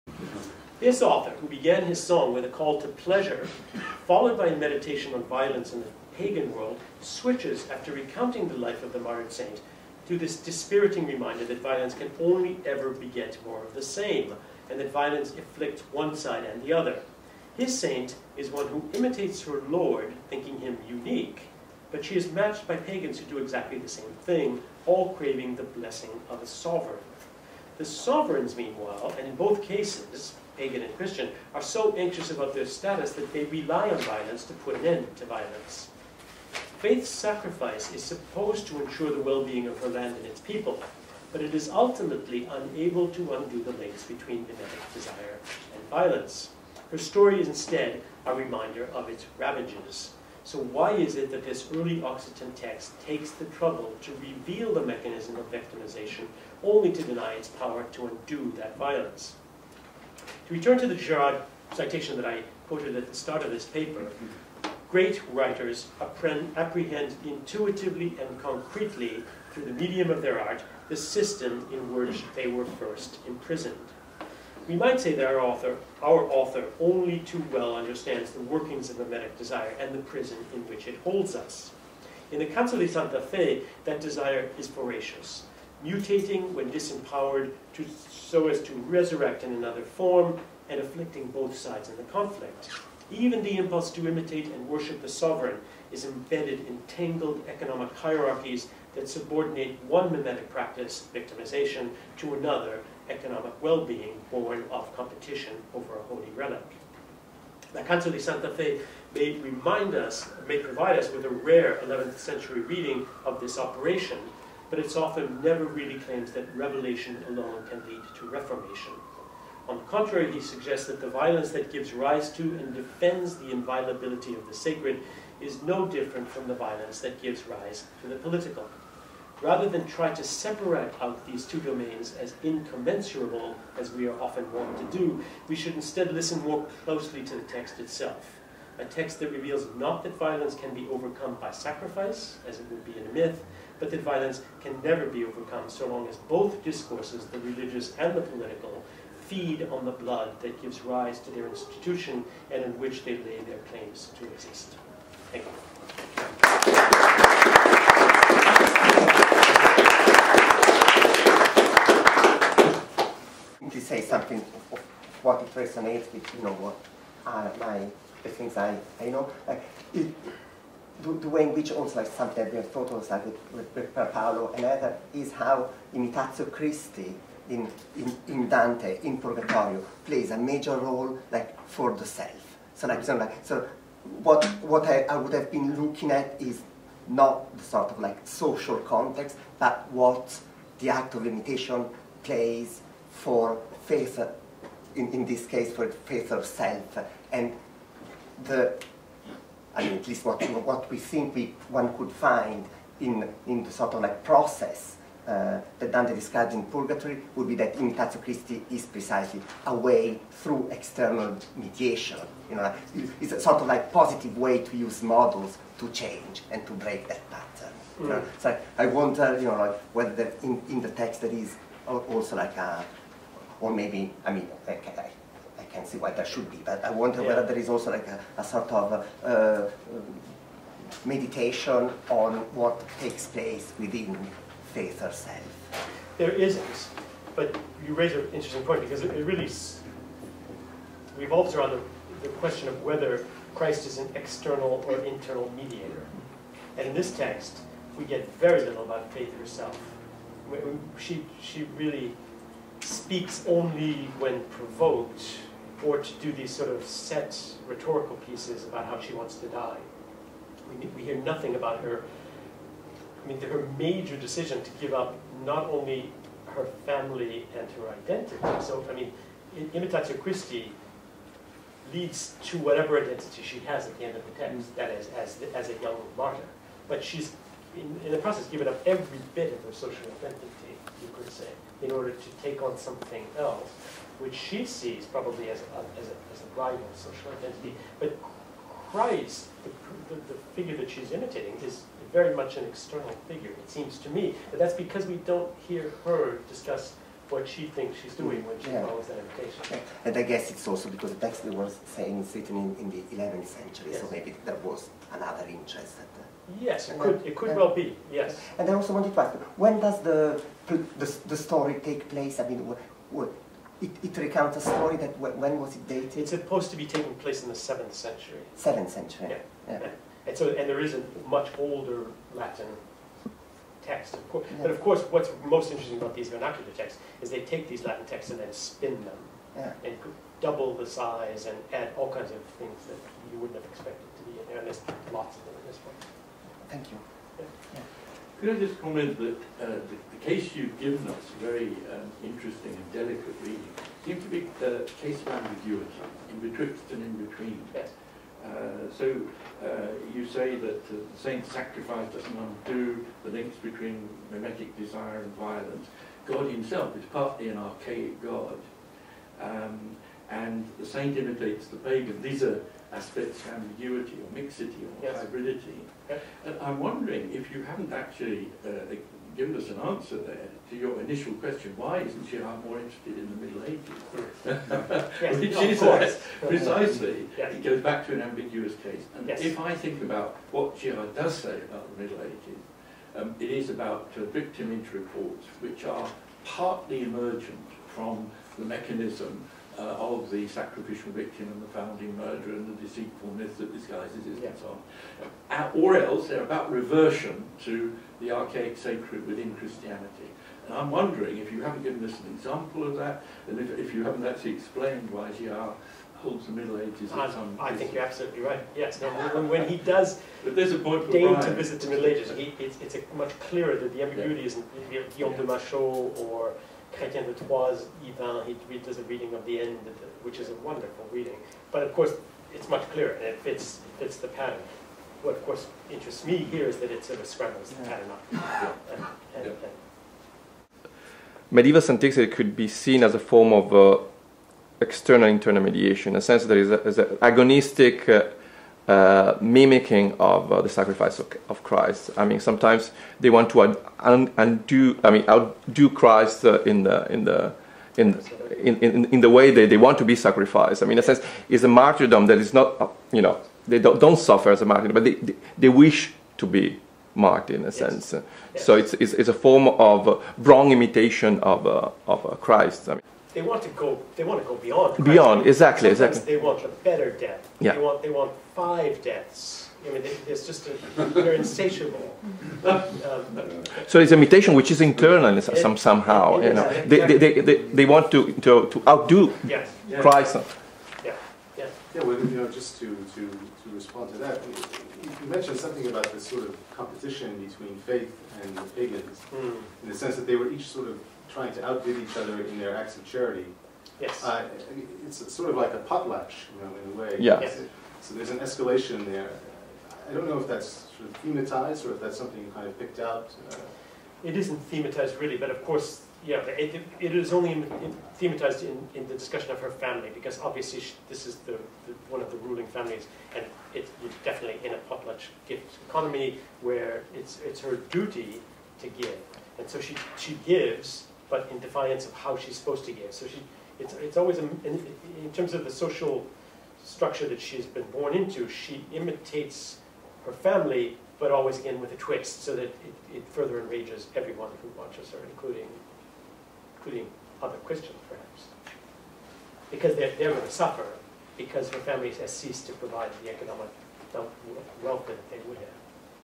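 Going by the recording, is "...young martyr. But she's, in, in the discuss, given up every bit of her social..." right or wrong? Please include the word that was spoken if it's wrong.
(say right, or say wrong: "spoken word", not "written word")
wrong: "process", not "discuss".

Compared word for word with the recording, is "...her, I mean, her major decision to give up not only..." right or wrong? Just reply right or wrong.
right.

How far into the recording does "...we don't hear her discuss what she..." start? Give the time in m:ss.
4:55.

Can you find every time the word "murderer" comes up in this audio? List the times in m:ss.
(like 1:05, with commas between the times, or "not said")
6:32.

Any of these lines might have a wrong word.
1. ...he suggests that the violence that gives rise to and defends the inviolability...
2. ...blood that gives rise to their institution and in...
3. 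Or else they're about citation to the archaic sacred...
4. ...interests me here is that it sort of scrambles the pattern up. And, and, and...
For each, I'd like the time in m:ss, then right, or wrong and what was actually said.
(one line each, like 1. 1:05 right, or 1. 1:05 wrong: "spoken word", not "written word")
1. 2:00 right
2. 2:29 right
3. 6:35 wrong: "reversion", not "citation"
4. 7:05 right.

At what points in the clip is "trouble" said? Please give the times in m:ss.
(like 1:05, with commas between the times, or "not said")
0:53.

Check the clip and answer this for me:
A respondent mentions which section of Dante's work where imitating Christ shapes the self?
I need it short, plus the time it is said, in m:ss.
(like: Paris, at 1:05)
Purgatorio, at 2:59.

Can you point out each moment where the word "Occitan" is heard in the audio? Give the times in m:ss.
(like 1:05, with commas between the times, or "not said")
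0:52.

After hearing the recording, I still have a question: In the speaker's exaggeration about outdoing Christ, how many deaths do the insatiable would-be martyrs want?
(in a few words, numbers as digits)
5.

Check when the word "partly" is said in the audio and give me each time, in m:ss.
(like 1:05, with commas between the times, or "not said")
5:57, 6:26.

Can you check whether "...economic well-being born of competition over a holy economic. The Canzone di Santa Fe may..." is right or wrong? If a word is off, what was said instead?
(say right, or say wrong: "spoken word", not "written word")
wrong: "relic", not "economic".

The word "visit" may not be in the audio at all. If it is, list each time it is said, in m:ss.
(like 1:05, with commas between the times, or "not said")
6:51.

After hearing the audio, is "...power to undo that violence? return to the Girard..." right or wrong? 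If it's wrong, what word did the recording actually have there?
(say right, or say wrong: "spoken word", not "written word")
right.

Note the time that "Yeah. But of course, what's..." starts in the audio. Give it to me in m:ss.
5:24.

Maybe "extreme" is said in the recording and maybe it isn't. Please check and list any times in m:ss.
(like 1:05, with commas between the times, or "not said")
not said.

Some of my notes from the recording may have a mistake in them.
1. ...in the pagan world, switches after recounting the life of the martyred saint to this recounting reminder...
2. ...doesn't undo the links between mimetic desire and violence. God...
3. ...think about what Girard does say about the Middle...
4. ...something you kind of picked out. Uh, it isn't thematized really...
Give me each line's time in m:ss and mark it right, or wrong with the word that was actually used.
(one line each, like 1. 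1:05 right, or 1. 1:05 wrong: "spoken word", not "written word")
1. 0:05 wrong: "dispiriting", not "recounting"
2. 5:52 right
3. 6:19 right
4. 8:22 right.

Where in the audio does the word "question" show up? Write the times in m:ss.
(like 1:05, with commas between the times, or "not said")
4:02, 6:11.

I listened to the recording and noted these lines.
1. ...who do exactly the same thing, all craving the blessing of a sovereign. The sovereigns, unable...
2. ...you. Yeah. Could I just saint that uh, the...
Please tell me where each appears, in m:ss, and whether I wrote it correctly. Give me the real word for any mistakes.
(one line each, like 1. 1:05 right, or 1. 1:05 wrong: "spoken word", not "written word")
1. 0:23 wrong: "meanwhile", not "unable"
2. 5:36 wrong: "comment", not "saint".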